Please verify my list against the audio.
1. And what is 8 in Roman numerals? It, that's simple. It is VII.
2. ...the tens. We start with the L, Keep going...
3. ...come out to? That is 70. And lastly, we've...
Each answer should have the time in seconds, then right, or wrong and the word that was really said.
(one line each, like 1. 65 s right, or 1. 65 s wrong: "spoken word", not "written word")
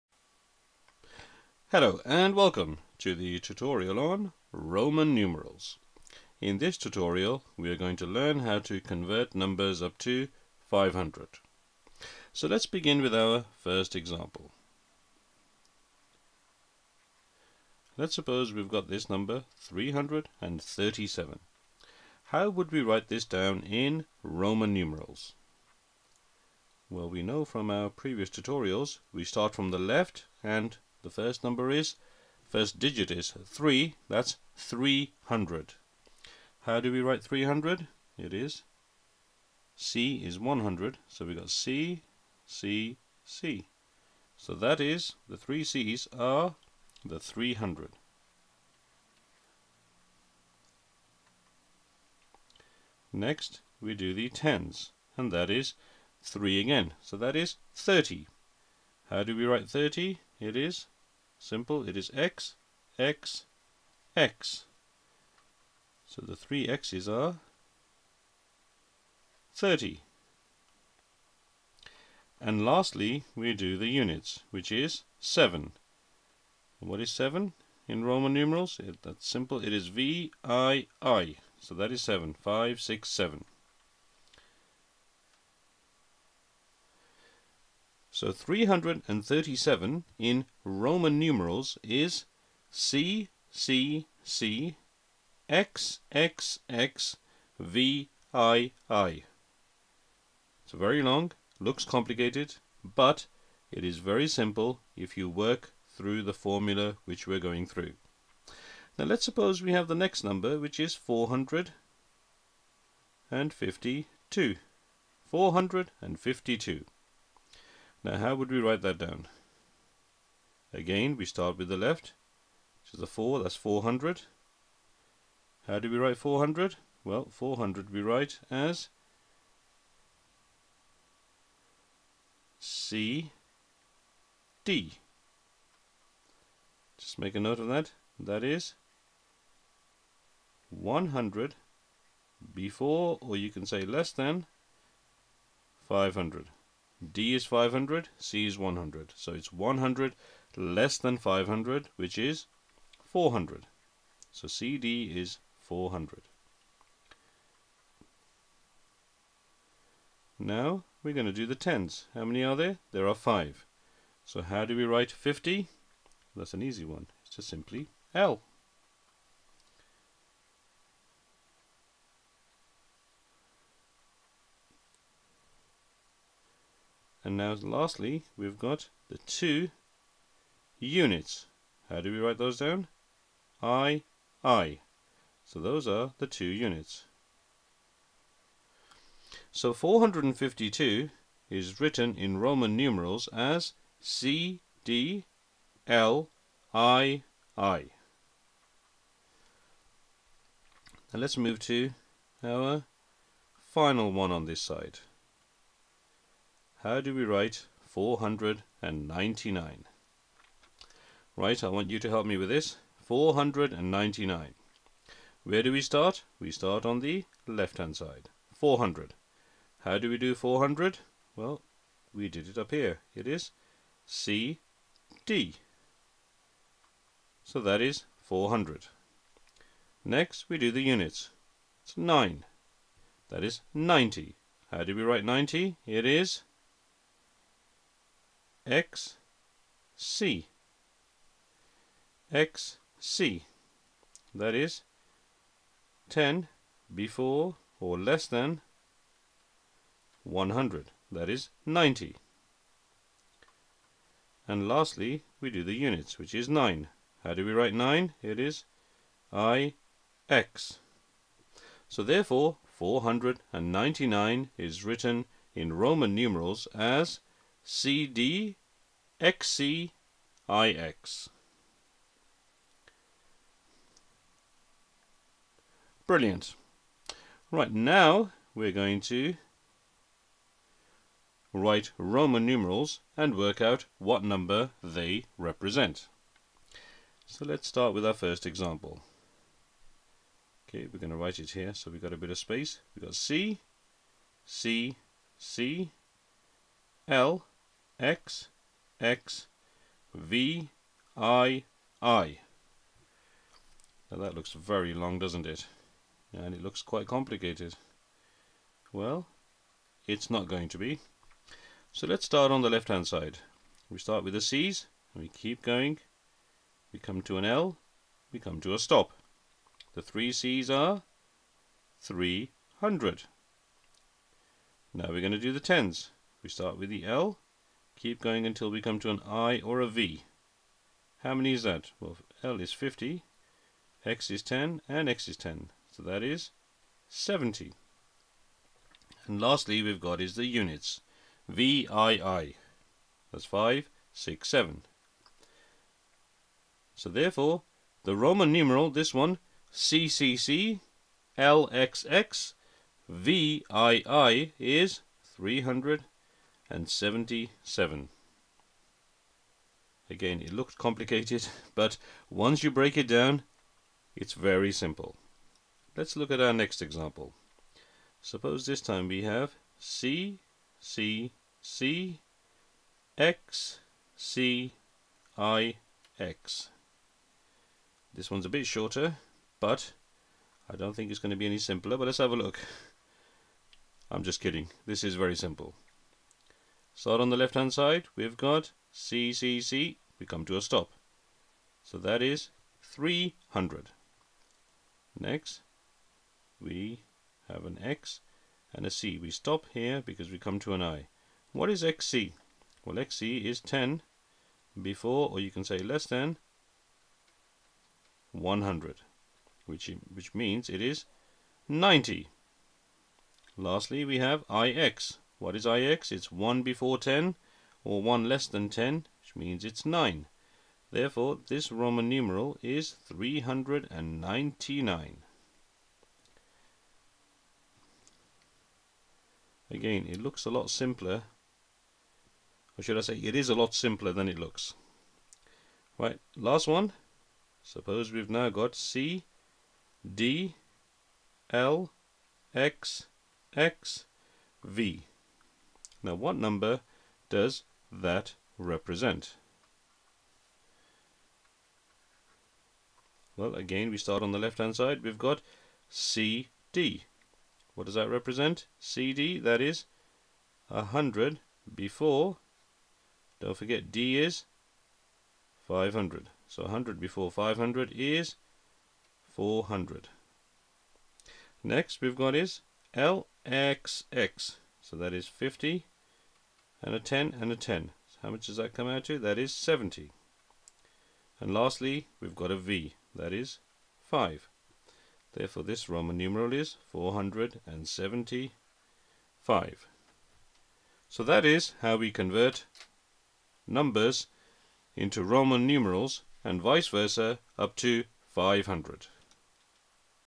1. 76 s wrong: "7", not "8"
2. 325 s right
3. 478 s right.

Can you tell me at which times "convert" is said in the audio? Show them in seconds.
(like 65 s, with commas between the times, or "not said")
8 s, 492 s.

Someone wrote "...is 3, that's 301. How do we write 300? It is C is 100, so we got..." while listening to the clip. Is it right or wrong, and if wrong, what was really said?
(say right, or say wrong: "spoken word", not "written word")
wrong: "300", not "301".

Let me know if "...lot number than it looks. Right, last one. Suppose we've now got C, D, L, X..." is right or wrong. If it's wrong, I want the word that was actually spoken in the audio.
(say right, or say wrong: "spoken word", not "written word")
wrong: "simpler", not "number".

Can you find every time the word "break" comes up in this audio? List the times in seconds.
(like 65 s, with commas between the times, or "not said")
362 s.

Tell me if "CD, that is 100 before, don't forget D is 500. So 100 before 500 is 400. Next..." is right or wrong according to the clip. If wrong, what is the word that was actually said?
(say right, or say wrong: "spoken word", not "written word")
right.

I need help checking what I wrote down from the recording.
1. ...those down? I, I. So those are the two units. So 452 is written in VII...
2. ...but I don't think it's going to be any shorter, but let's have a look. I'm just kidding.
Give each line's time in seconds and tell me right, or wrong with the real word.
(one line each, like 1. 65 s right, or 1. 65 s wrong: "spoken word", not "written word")
1. 182 s wrong: "Roman", not "VII"
2. 379 s wrong: "simpler", not "shorter".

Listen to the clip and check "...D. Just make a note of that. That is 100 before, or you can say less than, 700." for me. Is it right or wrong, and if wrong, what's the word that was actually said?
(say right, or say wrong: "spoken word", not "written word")
wrong: "500", not "700".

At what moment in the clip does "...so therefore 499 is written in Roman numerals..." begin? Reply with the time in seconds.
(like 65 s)
261 s.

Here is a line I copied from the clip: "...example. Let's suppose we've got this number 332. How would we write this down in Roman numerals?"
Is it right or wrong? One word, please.
wrong.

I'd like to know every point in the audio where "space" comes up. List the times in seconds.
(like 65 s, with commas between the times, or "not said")
292 s.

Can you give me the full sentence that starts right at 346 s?
So therefore, the Roman numeral, this one, CCC, LXX, VII is 300 and 77.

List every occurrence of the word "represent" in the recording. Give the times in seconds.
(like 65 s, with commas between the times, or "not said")
285 s, 448 s, 458 s.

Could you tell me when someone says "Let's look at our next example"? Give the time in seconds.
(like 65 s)
365 s.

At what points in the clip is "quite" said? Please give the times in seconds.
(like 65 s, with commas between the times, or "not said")
306 s.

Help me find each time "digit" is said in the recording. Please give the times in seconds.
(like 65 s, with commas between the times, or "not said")
32 s.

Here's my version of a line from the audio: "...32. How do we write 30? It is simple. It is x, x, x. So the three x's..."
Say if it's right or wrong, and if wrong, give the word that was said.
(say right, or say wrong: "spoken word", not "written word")
wrong: "30", not "32".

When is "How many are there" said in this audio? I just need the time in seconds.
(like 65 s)
162 s.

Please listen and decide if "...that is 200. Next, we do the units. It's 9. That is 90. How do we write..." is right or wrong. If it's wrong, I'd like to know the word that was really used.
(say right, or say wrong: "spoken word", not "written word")
wrong: "400", not "200".